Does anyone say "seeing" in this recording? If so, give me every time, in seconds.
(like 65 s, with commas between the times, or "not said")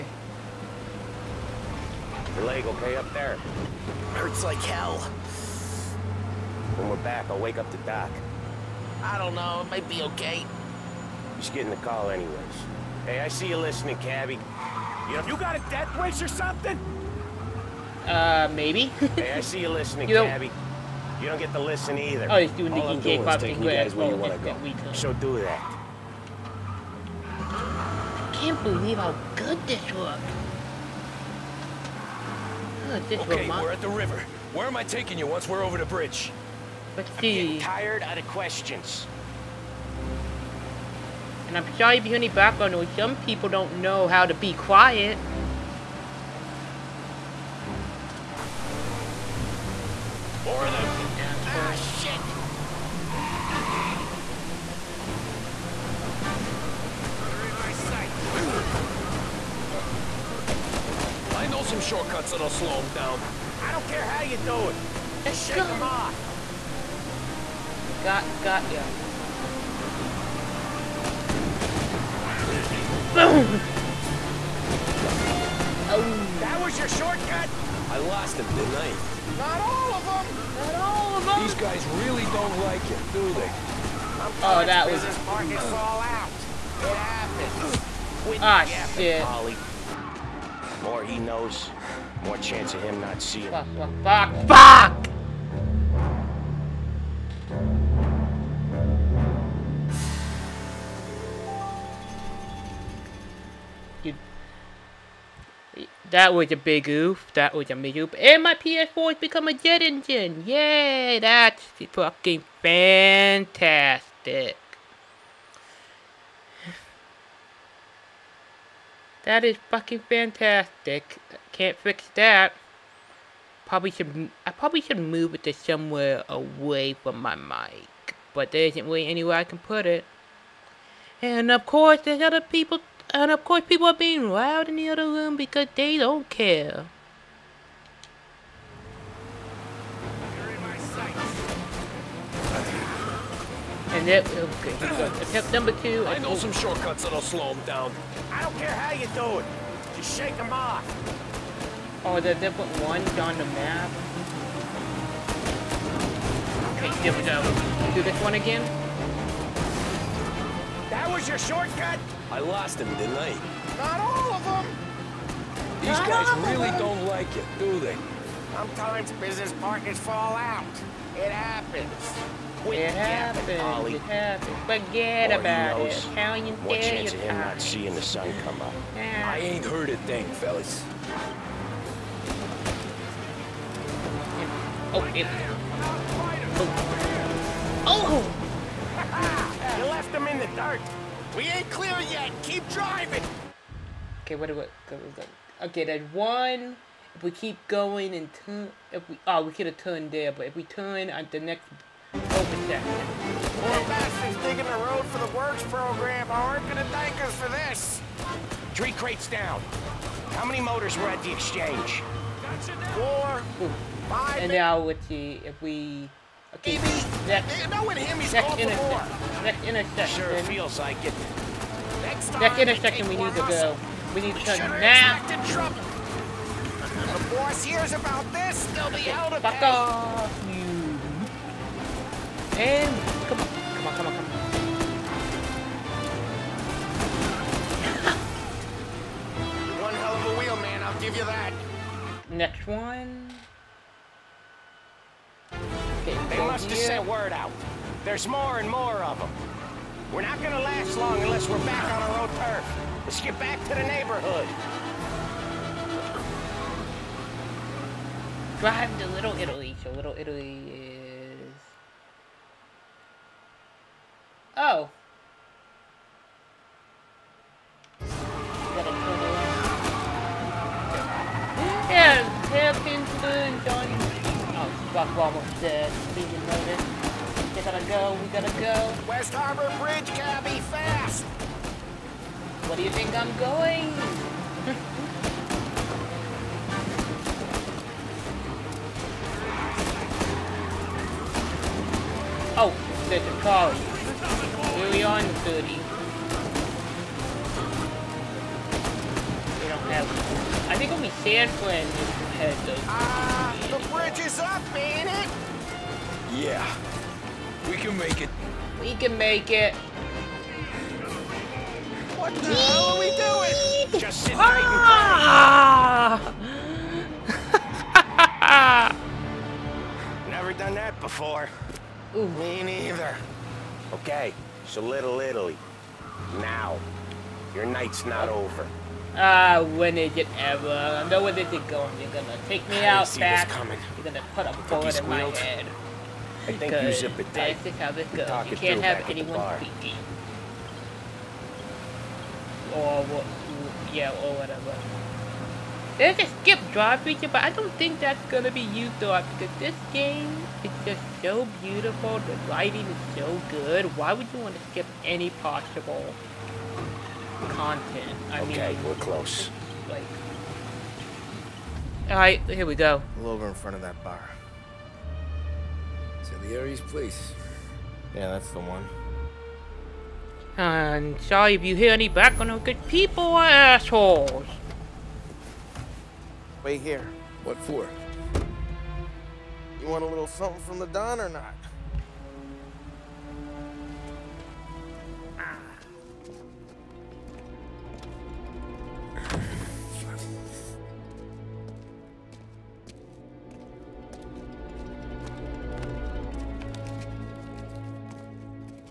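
93 s, 177 s.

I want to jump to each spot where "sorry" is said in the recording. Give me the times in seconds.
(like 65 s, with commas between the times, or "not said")
41 s, 371 s.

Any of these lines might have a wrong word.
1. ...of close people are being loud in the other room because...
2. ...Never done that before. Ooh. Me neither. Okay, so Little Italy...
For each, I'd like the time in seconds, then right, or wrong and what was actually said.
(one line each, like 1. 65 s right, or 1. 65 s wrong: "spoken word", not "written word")
1. 133 s wrong: "course", not "close"
2. 320 s right.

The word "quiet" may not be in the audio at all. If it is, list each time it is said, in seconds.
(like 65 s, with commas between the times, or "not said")
44 s.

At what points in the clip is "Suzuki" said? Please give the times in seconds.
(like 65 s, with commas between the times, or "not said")
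not said.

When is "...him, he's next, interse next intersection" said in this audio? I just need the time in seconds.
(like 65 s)
217 s.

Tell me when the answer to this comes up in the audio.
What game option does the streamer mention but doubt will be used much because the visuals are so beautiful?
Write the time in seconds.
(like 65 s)
346 s.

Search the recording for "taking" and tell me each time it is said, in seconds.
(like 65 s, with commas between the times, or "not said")
23 s, 34 s.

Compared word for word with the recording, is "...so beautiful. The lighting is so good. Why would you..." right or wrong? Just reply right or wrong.
right.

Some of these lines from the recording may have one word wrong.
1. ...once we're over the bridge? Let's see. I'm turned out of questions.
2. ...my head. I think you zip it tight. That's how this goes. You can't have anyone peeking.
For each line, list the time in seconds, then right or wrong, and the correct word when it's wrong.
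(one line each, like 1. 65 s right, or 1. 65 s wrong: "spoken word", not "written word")
1. 35 s wrong: "tired", not "turned"
2. 335 s right.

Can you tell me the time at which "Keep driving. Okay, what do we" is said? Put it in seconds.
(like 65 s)
192 s.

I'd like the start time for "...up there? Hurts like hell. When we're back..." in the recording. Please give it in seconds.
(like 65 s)
2 s.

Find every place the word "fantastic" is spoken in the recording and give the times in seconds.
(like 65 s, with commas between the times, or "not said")
112 s, 120 s.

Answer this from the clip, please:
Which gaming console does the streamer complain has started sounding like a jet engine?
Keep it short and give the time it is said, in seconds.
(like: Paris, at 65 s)
PS4, at 108 s.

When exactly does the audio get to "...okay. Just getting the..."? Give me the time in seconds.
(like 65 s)
10 s.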